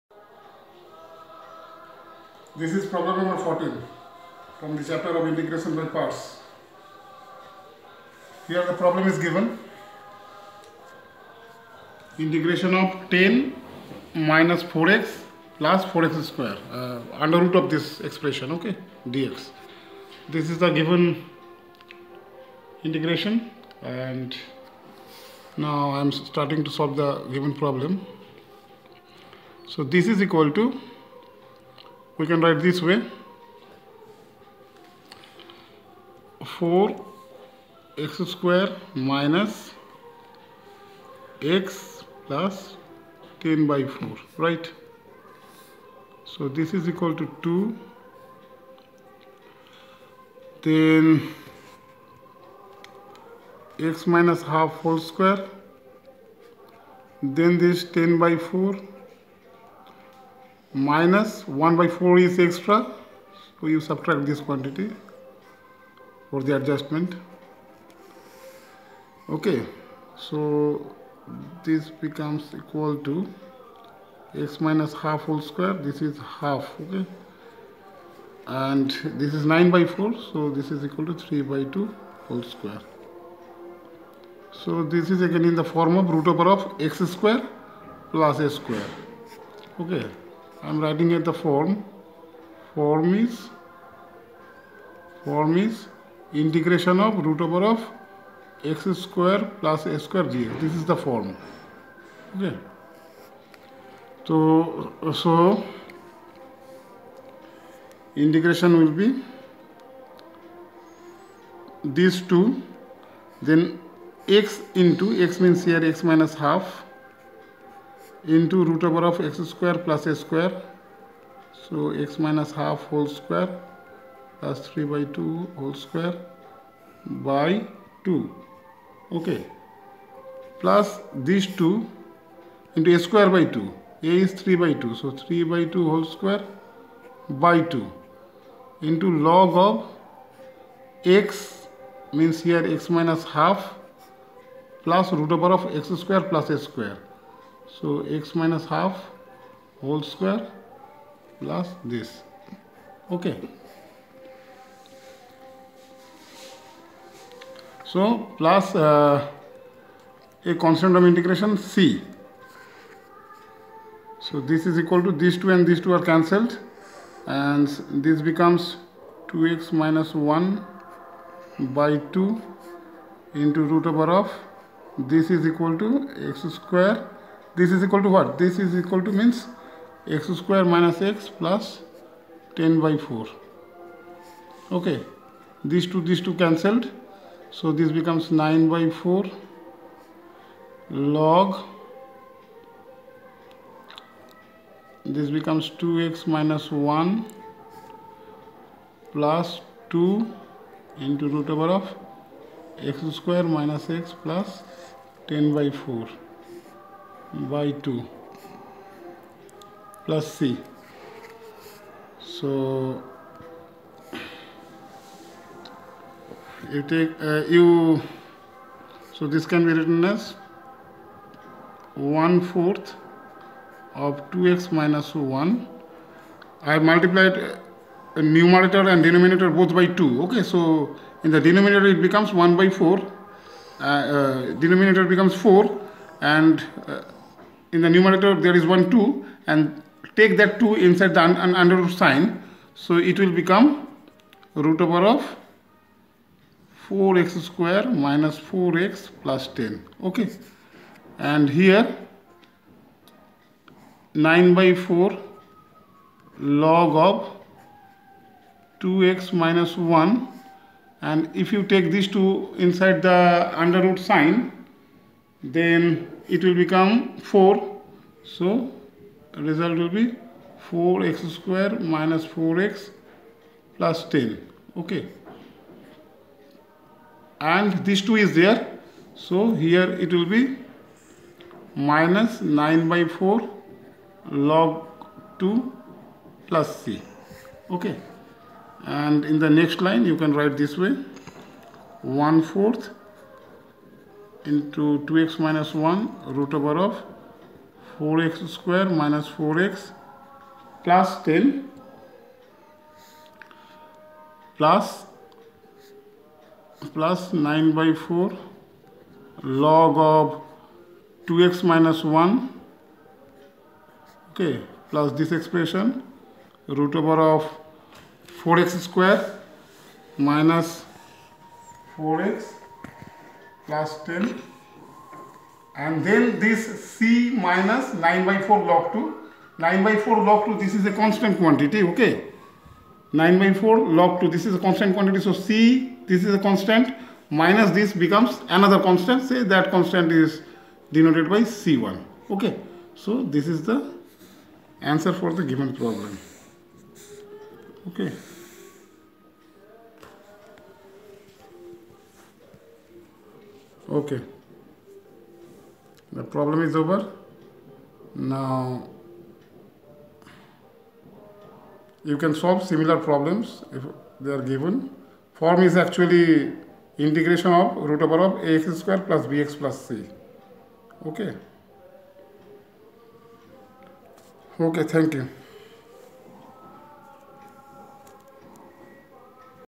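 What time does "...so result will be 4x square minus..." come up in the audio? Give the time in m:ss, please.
4:28.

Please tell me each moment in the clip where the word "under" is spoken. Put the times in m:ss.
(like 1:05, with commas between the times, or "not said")
0:17, 4:01, 4:23.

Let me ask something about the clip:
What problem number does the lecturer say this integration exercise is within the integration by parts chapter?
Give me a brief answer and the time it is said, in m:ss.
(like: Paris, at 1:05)
14, at 0:02.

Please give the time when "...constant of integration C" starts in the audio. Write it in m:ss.
2:40.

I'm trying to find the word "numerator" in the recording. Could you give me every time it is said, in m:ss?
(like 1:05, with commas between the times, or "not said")
3:48, 3:57.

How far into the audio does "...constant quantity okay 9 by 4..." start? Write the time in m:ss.
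5:30.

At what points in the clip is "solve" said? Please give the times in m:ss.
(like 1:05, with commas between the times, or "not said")
0:26, 6:02.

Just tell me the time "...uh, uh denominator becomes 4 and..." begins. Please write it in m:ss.
3:52.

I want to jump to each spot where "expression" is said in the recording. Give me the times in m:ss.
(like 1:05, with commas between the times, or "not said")
0:18, 5:15.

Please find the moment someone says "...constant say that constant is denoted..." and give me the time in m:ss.
5:38.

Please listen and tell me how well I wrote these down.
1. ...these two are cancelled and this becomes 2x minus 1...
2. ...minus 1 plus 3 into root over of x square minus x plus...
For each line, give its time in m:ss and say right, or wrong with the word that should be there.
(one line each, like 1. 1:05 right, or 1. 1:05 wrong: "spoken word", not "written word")
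1. 2:45 right
2. 3:16 wrong: "2", not "3".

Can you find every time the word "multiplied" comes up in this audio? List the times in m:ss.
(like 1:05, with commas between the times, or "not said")
3:46.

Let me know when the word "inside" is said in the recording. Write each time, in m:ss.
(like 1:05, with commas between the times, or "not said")
4:00, 4:22.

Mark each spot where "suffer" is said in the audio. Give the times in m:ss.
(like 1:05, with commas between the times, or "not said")
not said.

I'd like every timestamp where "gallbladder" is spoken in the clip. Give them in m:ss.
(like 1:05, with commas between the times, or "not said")
not said.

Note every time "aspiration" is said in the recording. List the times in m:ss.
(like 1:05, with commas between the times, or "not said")
not said.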